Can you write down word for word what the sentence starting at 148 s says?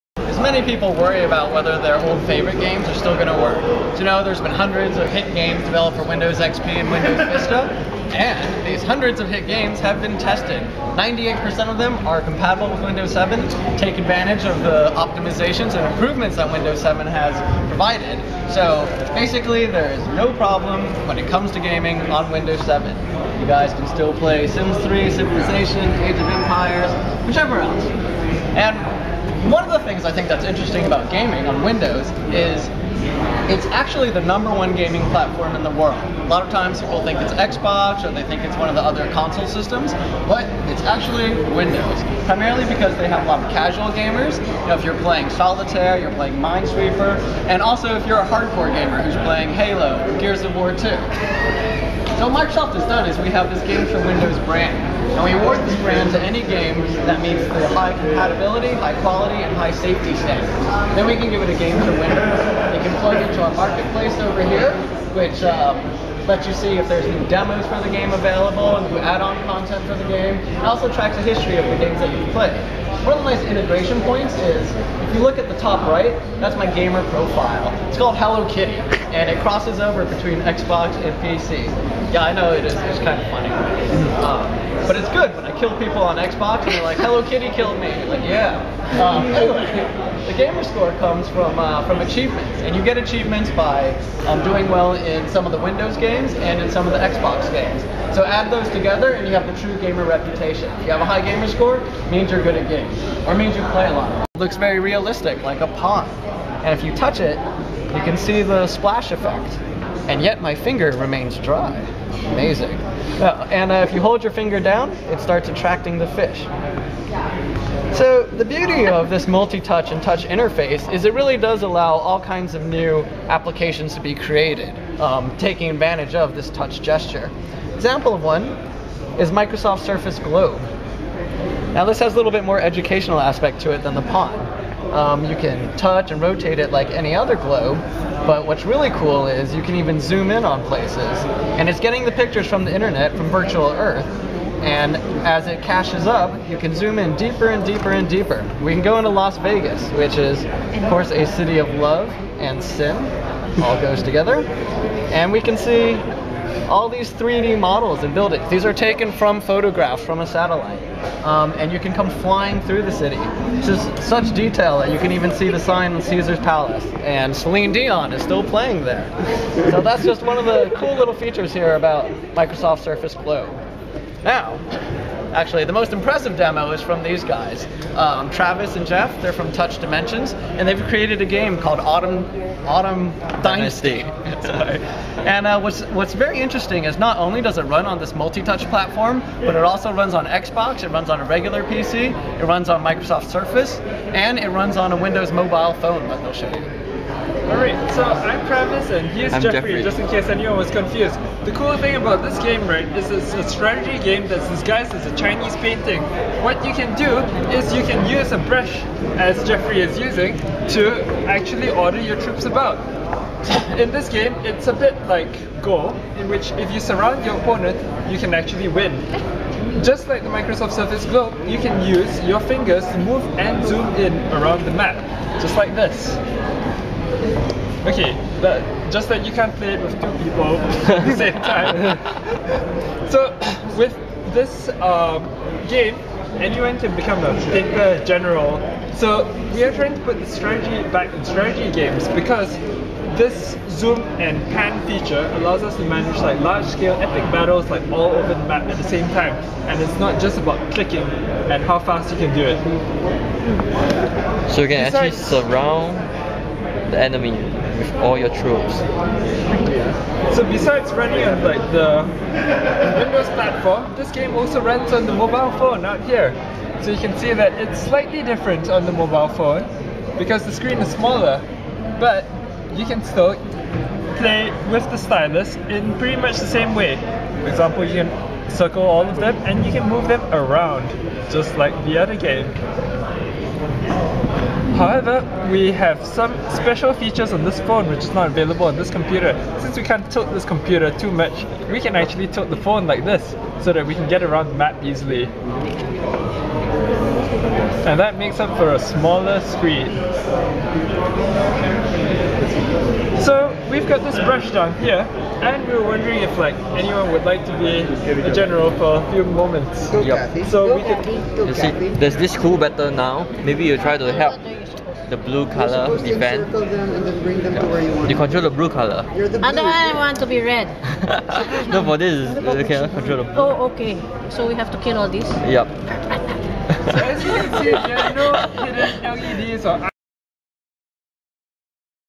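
We can go into Las Vegas, which is, of course, a city of love and sin.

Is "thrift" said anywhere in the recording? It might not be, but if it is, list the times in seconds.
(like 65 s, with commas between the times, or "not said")
not said.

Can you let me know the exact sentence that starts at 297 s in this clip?
And that makes up for a smaller screen.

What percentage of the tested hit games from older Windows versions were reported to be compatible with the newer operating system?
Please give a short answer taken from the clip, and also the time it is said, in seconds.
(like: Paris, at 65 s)
98%, at 10 s.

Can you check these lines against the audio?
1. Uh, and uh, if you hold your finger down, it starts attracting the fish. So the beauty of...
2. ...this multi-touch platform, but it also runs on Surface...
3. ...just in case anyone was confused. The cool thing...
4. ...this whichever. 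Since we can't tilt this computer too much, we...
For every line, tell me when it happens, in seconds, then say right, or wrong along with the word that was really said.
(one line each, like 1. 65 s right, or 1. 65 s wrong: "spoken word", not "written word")
1. 113 s right
2. 187 s wrong: "Xbox", not "Surface"
3. 199 s right
4. 288 s wrong: "computer", not "whichever".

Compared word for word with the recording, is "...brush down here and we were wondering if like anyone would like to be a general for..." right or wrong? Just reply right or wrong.
right.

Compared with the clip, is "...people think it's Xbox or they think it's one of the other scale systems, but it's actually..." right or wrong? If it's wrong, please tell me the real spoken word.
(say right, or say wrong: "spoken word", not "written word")
wrong: "console", not "scale".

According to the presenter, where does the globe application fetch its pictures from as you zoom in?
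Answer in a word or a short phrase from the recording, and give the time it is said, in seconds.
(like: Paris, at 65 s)
Virtual Earth, at 143 s.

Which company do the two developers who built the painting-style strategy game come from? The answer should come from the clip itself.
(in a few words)
Touch Dimensions.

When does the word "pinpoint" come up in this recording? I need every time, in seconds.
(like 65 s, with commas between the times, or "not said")
not said.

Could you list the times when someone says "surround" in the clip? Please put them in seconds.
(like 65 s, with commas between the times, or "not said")
216 s, 255 s.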